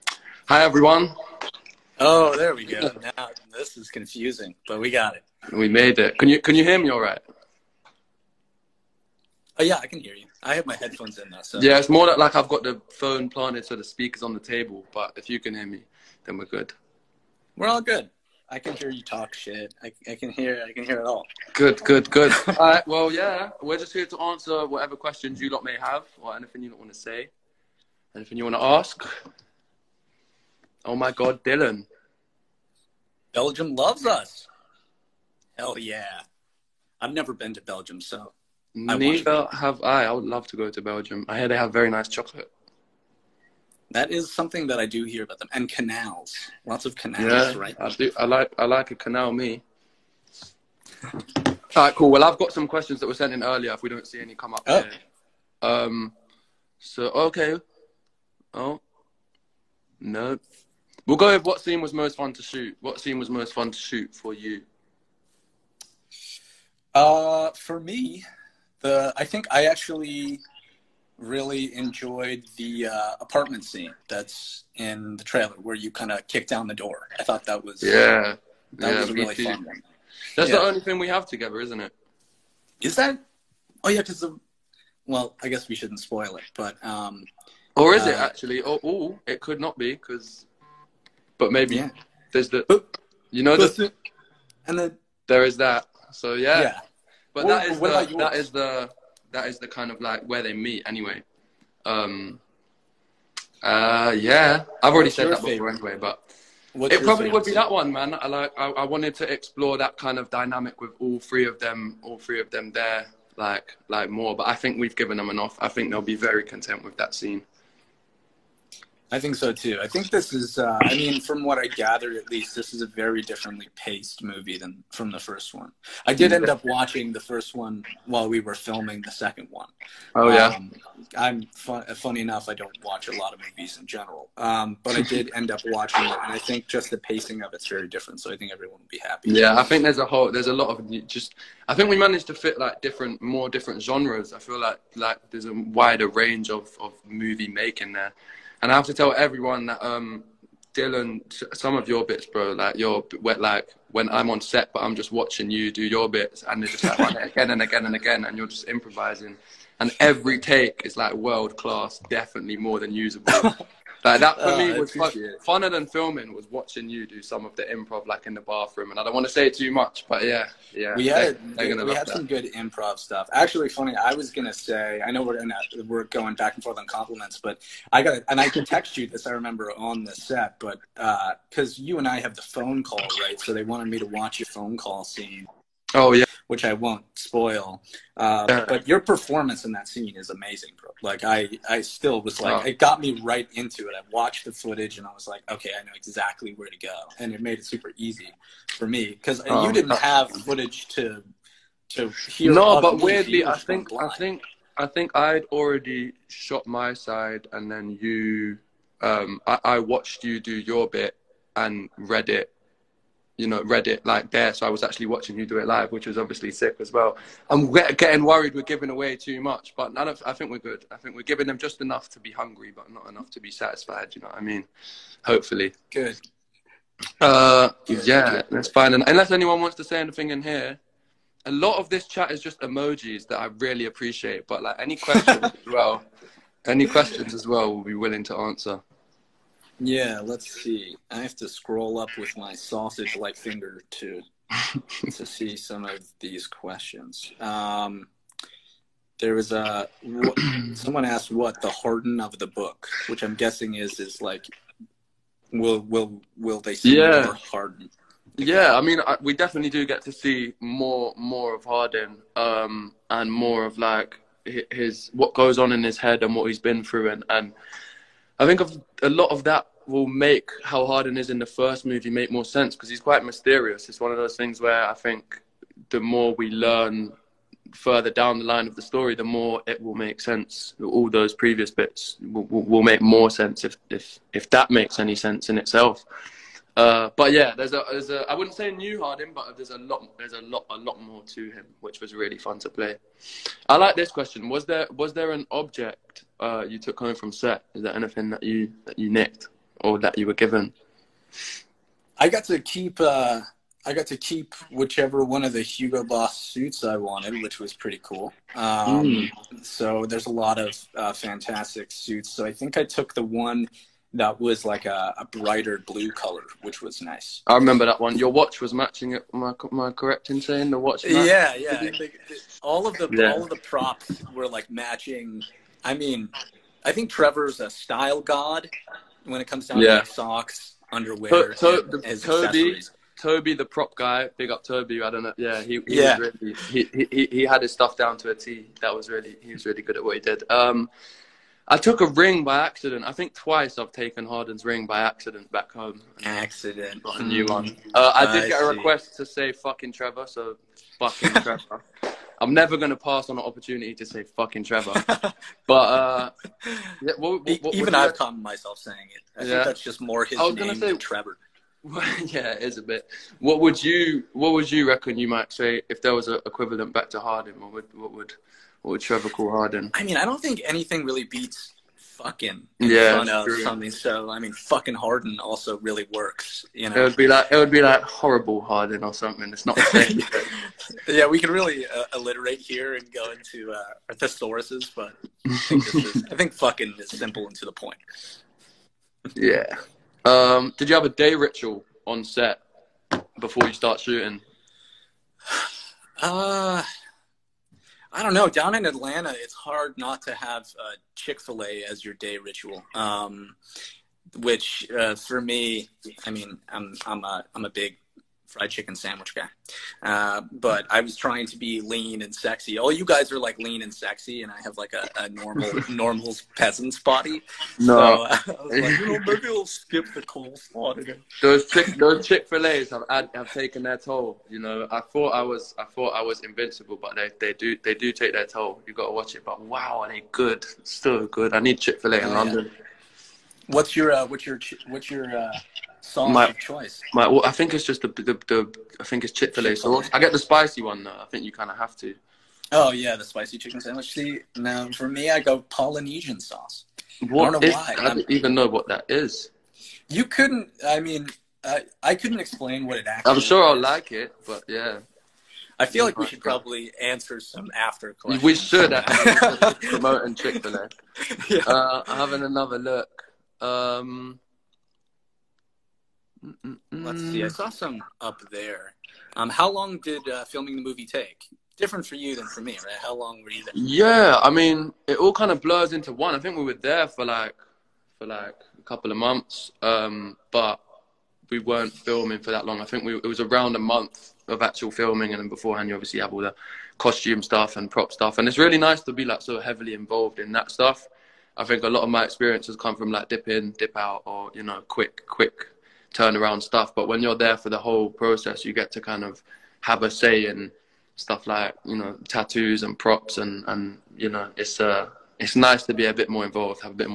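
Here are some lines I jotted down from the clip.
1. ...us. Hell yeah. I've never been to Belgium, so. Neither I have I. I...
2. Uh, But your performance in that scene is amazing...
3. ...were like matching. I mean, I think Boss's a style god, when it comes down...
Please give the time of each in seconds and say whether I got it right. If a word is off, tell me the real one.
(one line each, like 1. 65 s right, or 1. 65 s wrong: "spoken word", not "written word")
1. 34 s right
2. 188 s right
3. 324 s wrong: "Trevor", not "Boss".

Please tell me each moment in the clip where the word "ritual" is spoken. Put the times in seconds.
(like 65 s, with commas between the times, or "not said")
391 s, 402 s.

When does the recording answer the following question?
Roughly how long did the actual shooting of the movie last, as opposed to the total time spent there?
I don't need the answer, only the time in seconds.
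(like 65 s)
483 s.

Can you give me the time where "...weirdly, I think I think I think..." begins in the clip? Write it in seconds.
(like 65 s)
203 s.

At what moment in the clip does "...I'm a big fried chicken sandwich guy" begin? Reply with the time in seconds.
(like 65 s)
407 s.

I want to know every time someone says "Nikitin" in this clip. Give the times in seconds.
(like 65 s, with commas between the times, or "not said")
not said.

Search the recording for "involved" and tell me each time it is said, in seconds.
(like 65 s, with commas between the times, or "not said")
489 s, 506 s.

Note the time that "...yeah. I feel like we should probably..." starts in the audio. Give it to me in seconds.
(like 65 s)
454 s.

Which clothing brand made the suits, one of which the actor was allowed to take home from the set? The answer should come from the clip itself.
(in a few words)
Hugo Boss.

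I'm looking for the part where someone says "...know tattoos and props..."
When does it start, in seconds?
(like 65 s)
501 s.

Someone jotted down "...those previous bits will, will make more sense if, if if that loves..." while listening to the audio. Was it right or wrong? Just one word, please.
wrong.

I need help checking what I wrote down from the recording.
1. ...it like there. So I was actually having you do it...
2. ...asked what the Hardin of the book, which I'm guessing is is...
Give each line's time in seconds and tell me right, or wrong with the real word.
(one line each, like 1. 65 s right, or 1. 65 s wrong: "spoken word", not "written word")
1. 213 s wrong: "watching", not "having"
2. 251 s right.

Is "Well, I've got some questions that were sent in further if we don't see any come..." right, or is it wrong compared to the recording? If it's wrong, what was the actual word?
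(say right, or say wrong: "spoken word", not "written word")
wrong: "earlier", not "further".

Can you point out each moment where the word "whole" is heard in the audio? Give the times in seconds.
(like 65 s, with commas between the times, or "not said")
140 s, 497 s.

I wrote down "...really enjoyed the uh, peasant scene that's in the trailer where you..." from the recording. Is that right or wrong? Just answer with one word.
wrong.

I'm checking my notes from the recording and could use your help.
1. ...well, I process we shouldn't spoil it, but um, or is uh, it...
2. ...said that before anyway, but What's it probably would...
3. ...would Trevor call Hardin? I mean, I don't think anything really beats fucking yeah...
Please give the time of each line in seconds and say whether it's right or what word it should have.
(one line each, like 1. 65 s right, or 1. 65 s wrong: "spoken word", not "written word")
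1. 85 s wrong: "guess", not "process"
2. 105 s right
3. 368 s right.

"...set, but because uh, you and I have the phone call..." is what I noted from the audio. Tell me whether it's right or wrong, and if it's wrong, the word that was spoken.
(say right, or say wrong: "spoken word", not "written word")
right.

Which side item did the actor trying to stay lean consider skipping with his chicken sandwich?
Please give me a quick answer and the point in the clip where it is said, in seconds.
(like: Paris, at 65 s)
coleslaw, at 420 s.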